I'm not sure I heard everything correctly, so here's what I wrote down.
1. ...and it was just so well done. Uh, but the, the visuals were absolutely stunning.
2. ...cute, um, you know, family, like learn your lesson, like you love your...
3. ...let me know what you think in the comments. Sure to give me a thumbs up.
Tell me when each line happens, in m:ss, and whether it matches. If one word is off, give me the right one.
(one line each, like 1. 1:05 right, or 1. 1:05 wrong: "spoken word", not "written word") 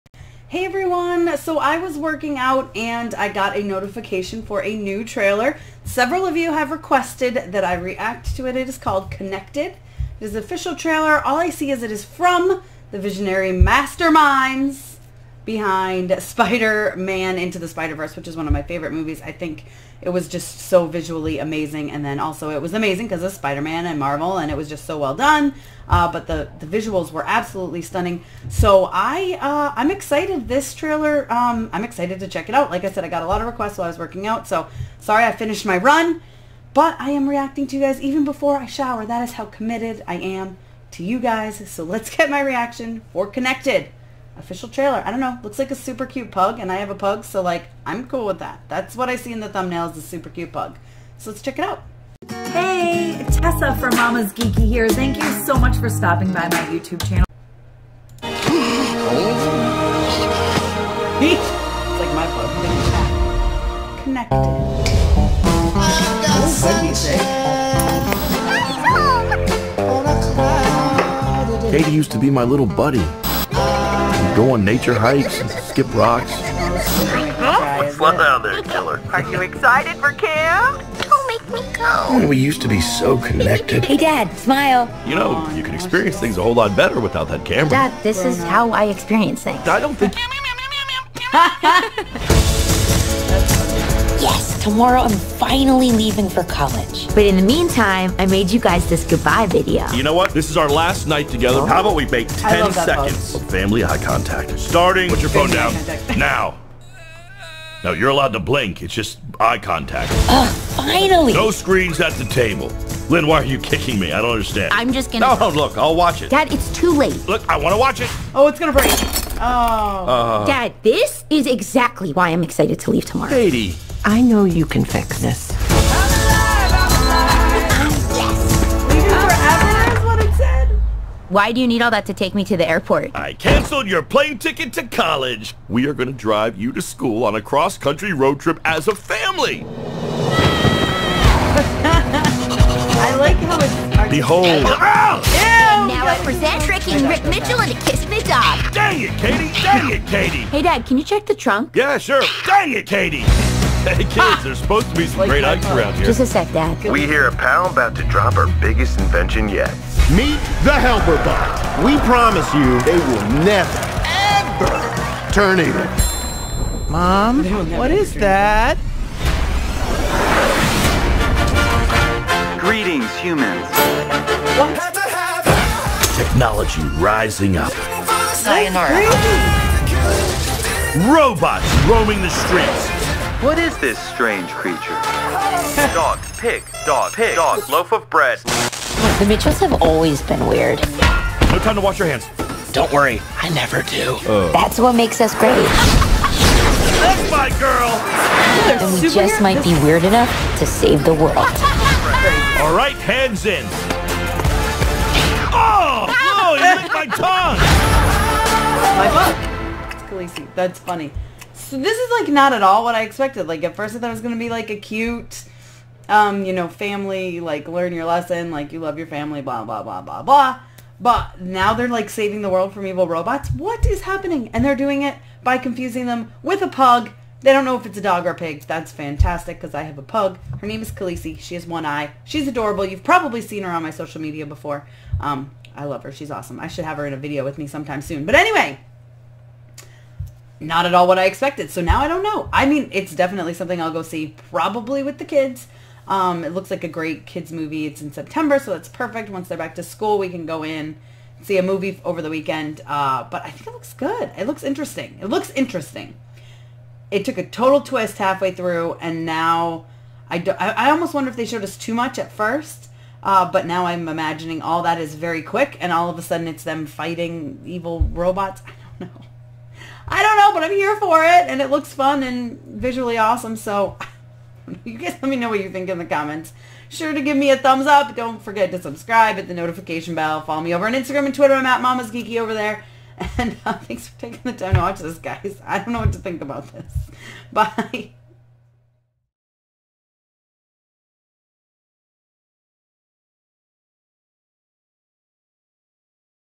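1. 0:24 right
2. 3:34 right
3. 4:35 right.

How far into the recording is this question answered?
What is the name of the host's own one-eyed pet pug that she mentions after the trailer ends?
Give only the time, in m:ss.
3:50.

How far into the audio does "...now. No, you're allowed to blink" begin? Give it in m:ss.
1:46.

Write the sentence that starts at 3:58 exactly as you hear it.
But anyway, not at all what I expected.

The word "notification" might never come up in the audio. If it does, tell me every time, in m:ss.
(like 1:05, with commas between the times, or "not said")
0:03, 4:39.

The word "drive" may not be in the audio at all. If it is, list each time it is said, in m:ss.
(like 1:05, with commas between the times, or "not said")
2:16.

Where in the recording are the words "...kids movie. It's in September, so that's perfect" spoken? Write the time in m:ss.
4:07.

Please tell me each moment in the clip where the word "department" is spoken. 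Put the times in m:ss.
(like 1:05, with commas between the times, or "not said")
not said.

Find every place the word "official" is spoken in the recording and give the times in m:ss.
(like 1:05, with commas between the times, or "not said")
0:10, 0:44.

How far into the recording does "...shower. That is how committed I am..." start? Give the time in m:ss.
0:38.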